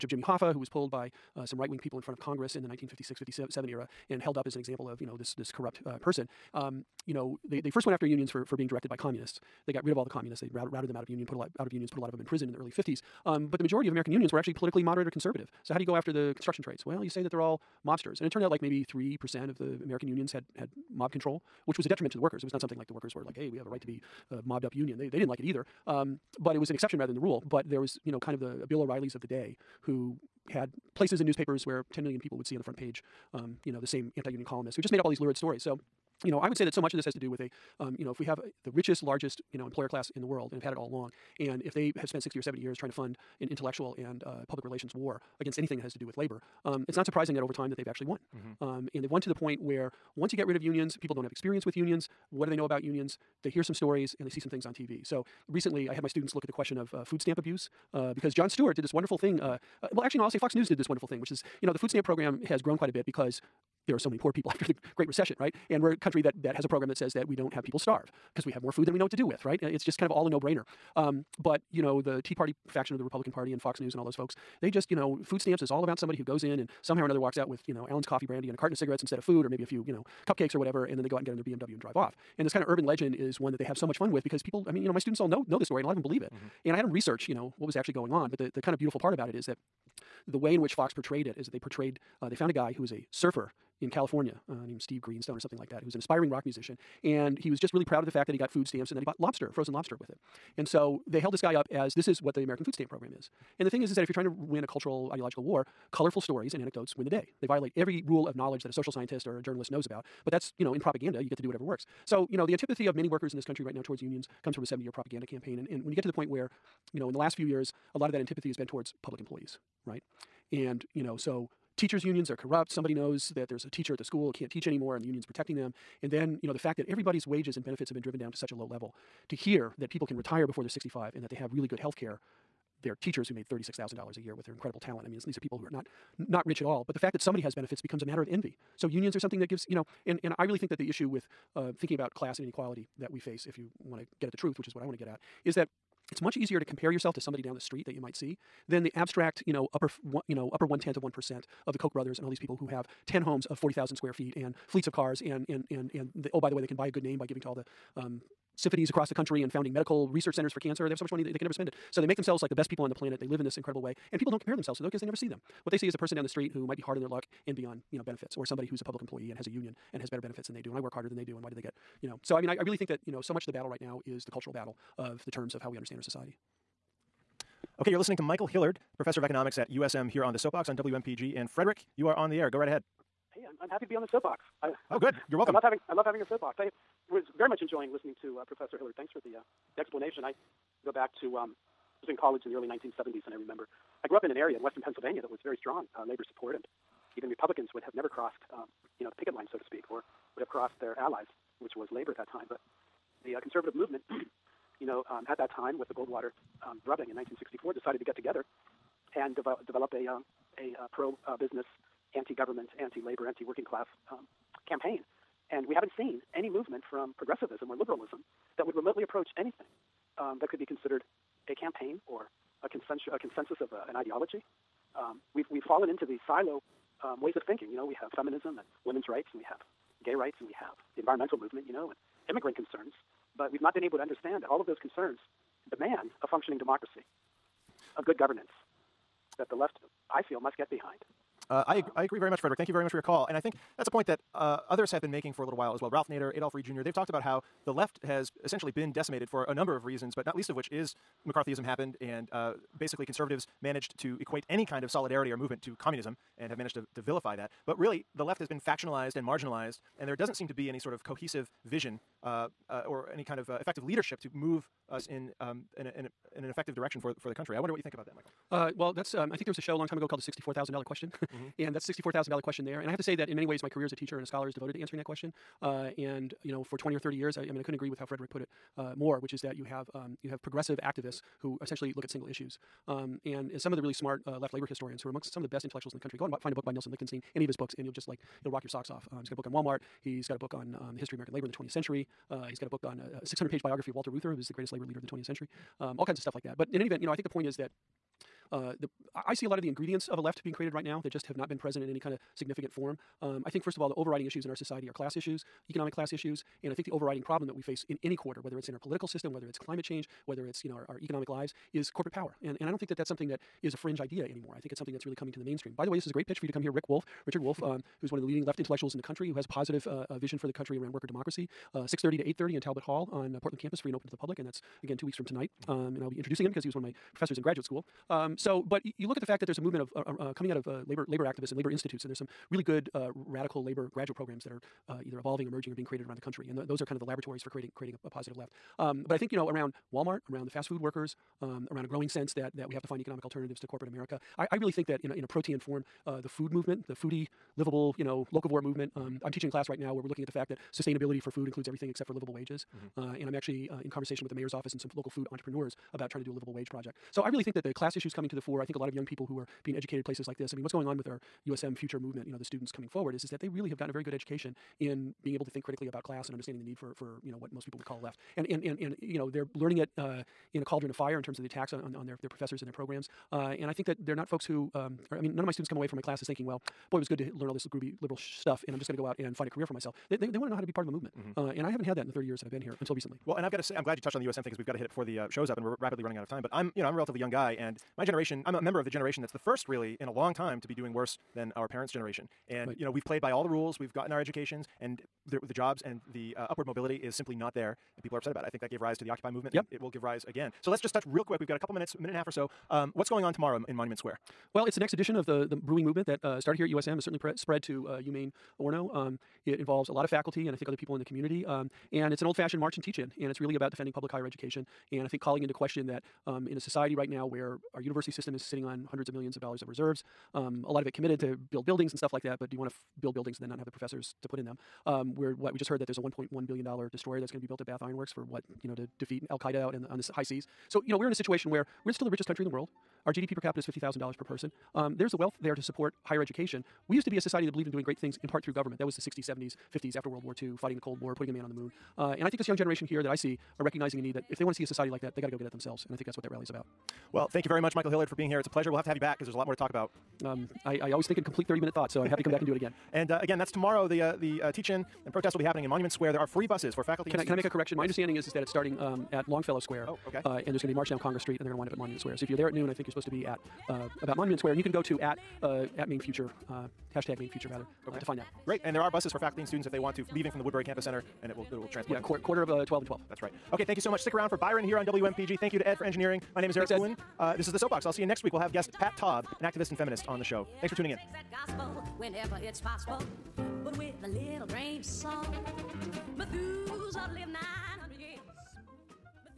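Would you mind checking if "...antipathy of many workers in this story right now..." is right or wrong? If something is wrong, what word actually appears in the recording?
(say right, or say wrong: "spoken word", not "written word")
wrong: "country", not "story".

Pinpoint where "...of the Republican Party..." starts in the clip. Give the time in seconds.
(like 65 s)
72 s.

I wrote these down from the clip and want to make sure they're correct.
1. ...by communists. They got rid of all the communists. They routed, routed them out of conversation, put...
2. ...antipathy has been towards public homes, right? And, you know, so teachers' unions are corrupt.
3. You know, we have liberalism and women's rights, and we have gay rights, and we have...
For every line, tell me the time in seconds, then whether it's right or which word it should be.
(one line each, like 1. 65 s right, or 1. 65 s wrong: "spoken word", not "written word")
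1. 8 s wrong: "union", not "conversation"
2. 118 s wrong: "employees", not "homes"
3. 227 s wrong: "feminism", not "liberalism".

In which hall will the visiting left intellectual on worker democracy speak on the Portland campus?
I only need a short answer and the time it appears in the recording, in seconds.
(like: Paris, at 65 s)
Talbot Hall, at 322 s.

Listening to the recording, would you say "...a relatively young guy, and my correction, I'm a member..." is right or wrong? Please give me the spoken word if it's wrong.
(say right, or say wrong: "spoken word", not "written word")
wrong: "generation", not "correction".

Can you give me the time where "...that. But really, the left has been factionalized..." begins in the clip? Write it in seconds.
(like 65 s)
257 s.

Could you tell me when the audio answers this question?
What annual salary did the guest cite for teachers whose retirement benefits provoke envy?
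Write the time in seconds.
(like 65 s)
133 s.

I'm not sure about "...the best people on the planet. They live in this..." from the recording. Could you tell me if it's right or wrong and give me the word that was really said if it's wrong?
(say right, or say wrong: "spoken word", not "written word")
right.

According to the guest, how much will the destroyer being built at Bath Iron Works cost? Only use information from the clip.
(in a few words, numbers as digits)
1.1 billion dollars.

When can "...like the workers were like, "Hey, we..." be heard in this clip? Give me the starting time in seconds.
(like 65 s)
22 s.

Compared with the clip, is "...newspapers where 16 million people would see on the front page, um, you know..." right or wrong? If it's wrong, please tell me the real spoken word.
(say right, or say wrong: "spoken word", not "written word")
wrong: "10", not "16".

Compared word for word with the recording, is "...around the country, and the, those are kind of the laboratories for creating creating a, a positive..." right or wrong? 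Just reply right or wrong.
right.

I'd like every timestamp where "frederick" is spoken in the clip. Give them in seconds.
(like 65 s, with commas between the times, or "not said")
181 s, 242 s, 278 s.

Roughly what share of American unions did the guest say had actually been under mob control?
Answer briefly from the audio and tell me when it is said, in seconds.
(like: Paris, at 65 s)
3 percent, at 18 s.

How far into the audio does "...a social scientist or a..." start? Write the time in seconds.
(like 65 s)
108 s.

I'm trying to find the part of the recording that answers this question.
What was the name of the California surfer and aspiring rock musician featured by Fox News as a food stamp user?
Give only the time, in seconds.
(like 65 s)
94 s.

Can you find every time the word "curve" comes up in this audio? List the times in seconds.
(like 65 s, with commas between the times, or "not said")
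not said.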